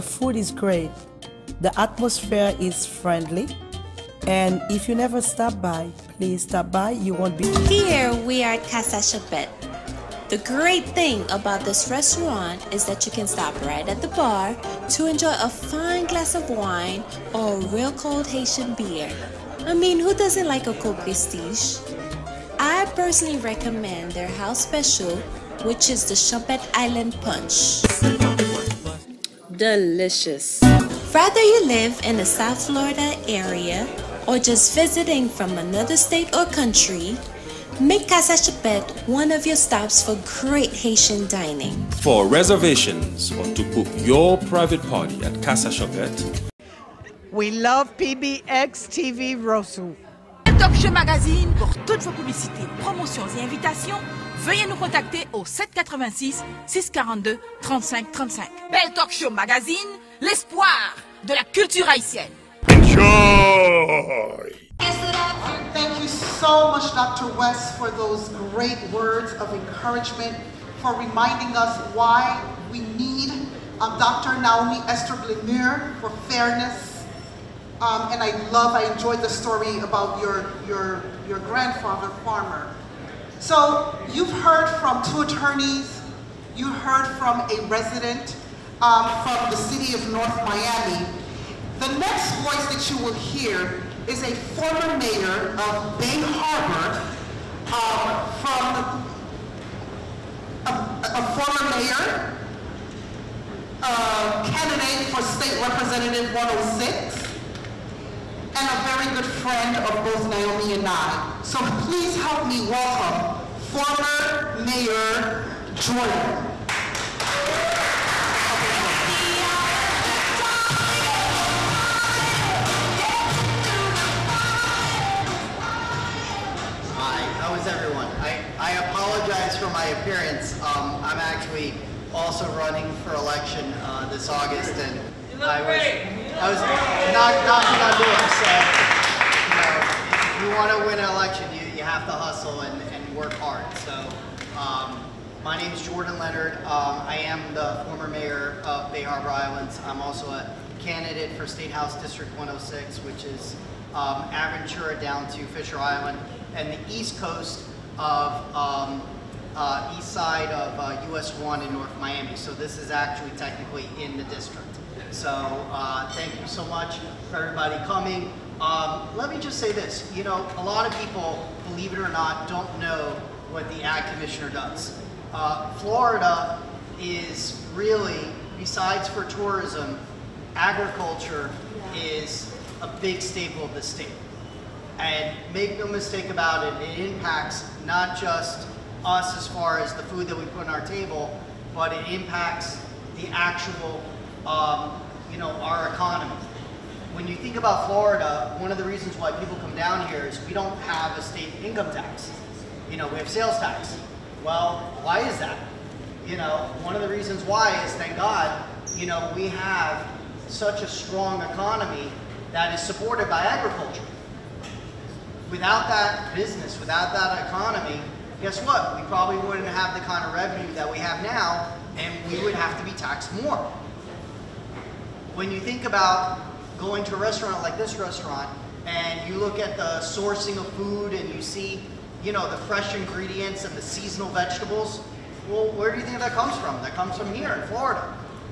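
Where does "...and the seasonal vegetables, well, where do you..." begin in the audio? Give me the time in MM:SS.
03:53.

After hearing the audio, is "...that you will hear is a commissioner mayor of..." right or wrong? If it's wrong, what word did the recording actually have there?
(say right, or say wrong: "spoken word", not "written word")
wrong: "former", not "commissioner".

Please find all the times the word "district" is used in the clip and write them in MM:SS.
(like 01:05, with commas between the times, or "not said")
02:32, 02:44.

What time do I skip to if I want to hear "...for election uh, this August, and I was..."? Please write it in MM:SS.
02:13.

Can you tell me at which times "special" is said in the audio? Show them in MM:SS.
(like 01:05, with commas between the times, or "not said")
00:24.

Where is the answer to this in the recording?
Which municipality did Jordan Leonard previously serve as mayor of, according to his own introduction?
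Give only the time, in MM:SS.
02:28.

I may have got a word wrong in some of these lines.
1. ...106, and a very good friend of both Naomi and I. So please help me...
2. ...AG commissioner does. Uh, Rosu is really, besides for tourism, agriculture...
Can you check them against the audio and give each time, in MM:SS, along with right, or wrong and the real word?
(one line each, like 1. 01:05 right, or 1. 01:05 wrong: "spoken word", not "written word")
1. 01:46 right
2. 02:53 wrong: "Florida", not "Rosu".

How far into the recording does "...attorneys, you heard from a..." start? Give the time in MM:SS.
01:25.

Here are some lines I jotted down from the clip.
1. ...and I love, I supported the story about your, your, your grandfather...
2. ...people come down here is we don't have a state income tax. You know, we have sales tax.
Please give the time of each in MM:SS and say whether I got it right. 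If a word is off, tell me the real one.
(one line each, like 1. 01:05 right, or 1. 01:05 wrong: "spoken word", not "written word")
1. 01:18 wrong: "enjoyed", not "supported"
2. 03:19 right.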